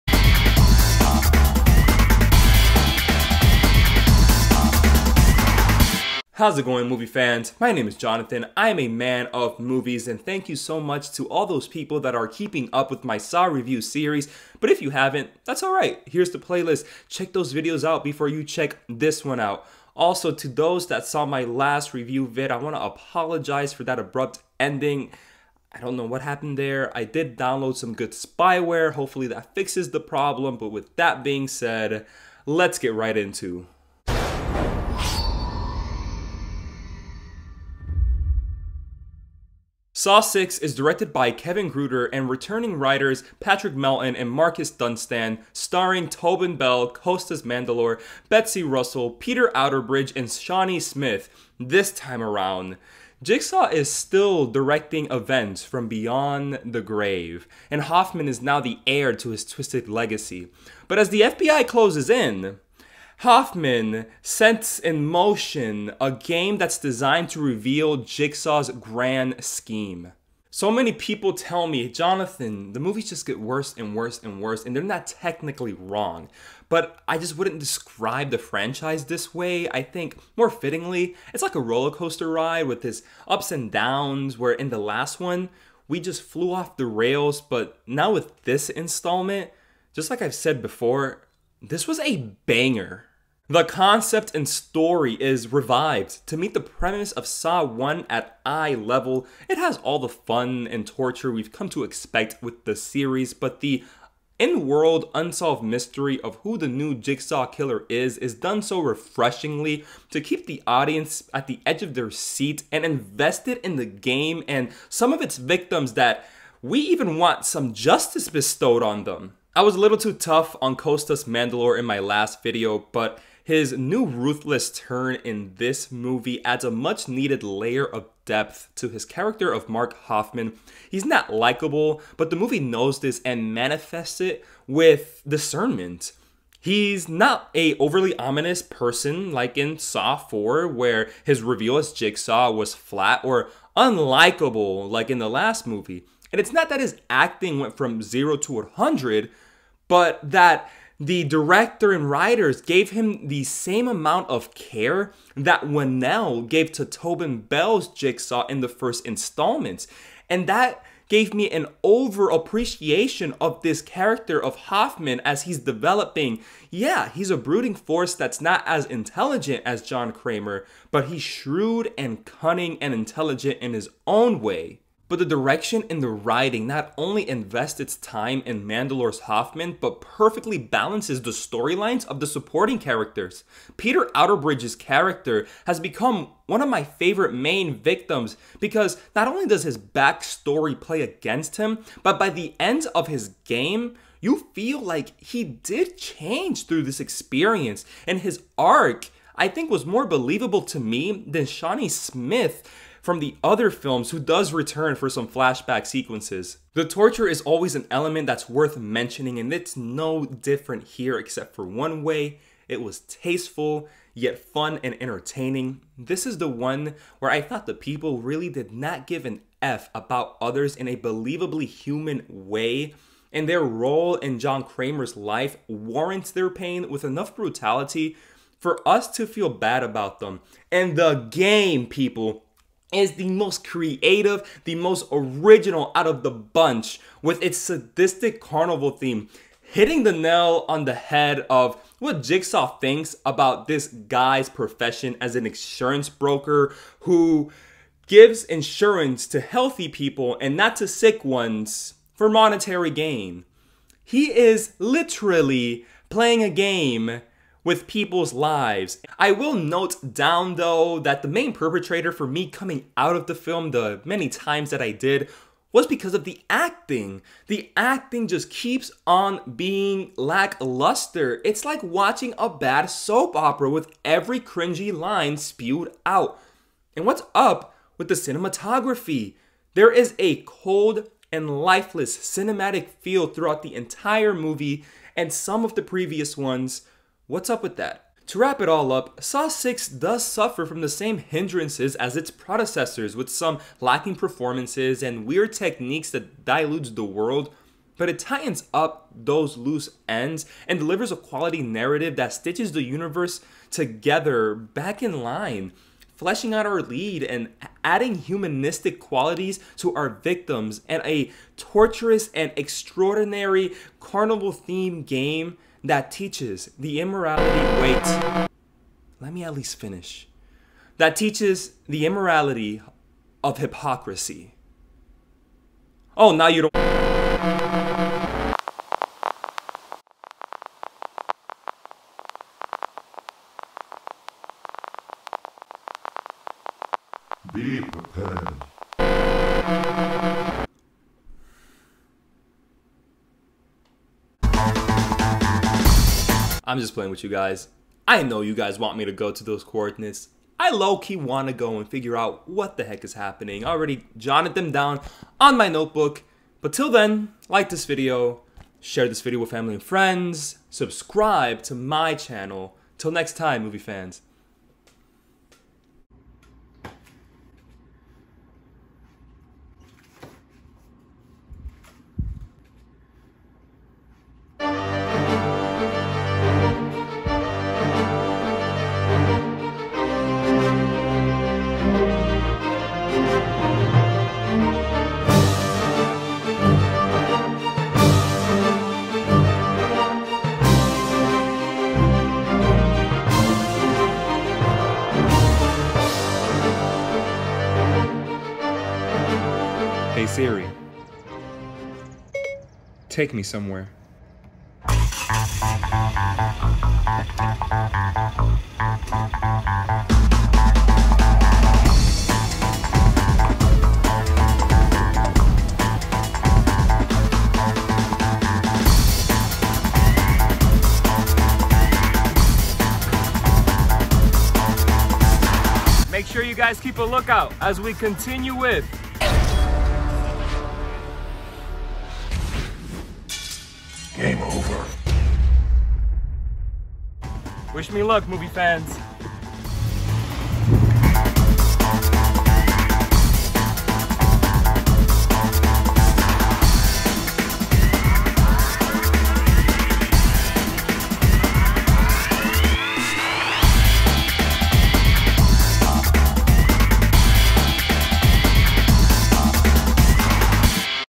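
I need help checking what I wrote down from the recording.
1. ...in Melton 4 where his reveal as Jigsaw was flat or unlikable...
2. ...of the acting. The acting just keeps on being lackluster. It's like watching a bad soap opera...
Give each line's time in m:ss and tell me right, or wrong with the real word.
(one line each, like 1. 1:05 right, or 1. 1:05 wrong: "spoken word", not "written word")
1. 2:19 wrong: "Saw", not "Melton"
2. 4:26 right.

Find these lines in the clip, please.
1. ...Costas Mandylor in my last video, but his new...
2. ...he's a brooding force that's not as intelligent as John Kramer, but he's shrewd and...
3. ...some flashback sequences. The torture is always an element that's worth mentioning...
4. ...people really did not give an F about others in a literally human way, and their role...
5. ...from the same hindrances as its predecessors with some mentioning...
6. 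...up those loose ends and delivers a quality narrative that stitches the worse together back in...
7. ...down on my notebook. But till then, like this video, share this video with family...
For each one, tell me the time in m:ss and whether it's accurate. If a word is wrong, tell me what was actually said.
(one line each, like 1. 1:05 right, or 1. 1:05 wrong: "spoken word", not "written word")
1. 2:00 right
2. 2:47 right
3. 3:25 right
4. 3:37 wrong: "believably", not "literally"
5. 4:50 wrong: "lacking", not "mentioning"
6. 4:58 wrong: "universe", not "worse"
7. 5:54 right.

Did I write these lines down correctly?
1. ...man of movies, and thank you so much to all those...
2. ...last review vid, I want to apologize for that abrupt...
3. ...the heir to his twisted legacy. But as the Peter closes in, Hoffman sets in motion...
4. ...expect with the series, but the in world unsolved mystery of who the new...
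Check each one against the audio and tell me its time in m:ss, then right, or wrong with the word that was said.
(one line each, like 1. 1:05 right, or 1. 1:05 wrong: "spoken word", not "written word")
1. 0:08 right
2. 0:21 right
3. 0:58 wrong: "FBI", not "Peter"
4. 1:41 right.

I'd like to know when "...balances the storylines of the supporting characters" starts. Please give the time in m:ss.
3:00.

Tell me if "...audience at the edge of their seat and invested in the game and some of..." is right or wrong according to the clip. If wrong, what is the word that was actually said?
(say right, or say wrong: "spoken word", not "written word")
right.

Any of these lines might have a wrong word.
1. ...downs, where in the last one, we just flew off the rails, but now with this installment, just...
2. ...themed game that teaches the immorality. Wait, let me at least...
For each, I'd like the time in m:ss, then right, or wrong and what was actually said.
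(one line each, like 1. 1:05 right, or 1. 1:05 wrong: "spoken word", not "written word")
1. 1:23 right
2. 5:14 right.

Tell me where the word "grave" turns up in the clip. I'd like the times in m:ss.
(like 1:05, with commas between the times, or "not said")
0:56.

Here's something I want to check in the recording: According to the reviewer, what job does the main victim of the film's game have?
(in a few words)
insurance broker.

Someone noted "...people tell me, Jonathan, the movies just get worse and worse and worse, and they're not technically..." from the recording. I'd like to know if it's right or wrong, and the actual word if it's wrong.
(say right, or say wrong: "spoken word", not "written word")
right.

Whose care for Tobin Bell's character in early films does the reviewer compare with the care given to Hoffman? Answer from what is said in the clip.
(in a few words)
Whannell.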